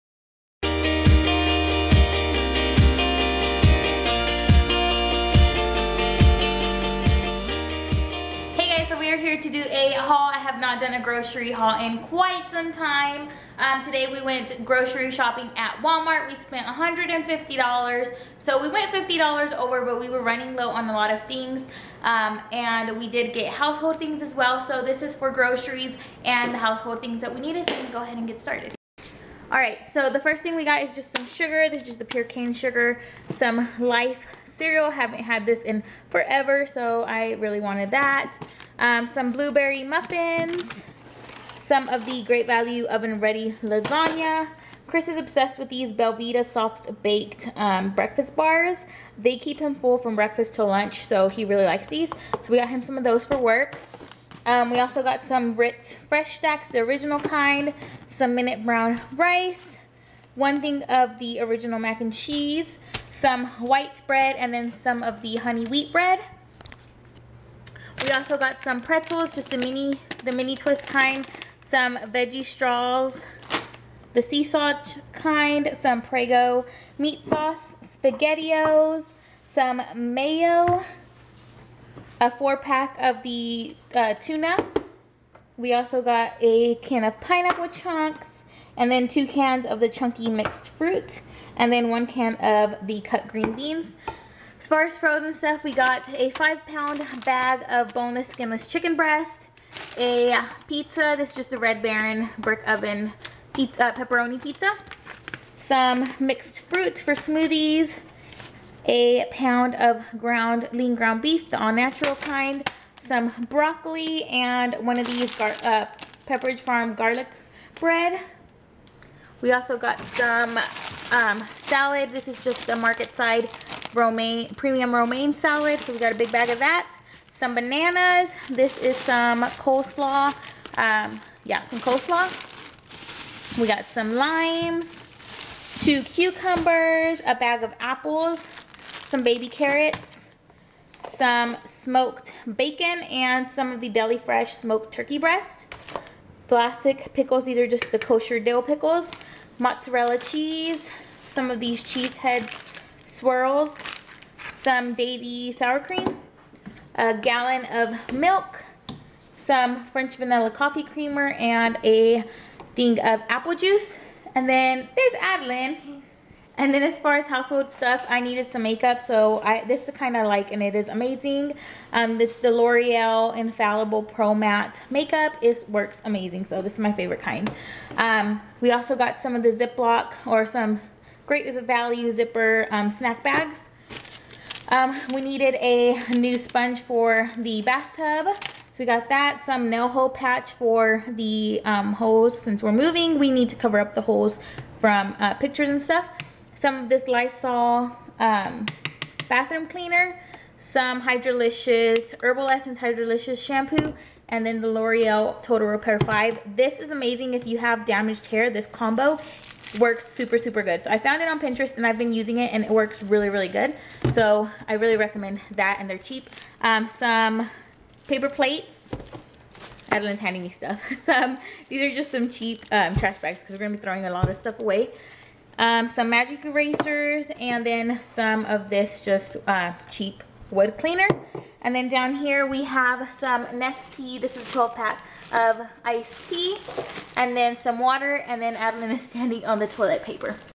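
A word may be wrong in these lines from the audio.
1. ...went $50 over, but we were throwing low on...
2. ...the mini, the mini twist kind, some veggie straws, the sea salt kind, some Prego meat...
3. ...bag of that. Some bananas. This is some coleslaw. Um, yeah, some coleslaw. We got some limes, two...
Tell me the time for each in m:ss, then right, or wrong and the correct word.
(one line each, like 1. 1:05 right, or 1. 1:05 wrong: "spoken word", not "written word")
1. 0:18 wrong: "running", not "throwing"
2. 1:09 right
3. 2:06 right.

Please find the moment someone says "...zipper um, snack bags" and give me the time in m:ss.
3:02.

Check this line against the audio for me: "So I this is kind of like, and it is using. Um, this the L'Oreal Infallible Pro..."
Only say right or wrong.
wrong.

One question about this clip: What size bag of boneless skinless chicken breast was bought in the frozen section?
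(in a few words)
5 pound.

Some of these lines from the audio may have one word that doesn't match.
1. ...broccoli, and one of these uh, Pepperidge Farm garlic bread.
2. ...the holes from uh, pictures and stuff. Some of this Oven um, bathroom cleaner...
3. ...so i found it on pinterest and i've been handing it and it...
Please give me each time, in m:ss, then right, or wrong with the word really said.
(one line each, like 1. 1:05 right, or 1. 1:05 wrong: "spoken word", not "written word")
1. 1:53 right
2. 3:13 wrong: "Lysol", not "Oven"
3. 3:30 wrong: "using", not "handing".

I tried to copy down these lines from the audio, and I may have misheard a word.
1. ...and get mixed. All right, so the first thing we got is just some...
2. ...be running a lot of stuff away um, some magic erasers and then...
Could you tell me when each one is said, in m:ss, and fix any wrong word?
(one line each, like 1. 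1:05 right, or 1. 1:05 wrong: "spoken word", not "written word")
1. 0:28 wrong: "started", not "mixed"
2. 3:43 wrong: "throwing", not "running".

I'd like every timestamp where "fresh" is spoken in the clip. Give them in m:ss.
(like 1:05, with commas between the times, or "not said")
0:56, 2:24.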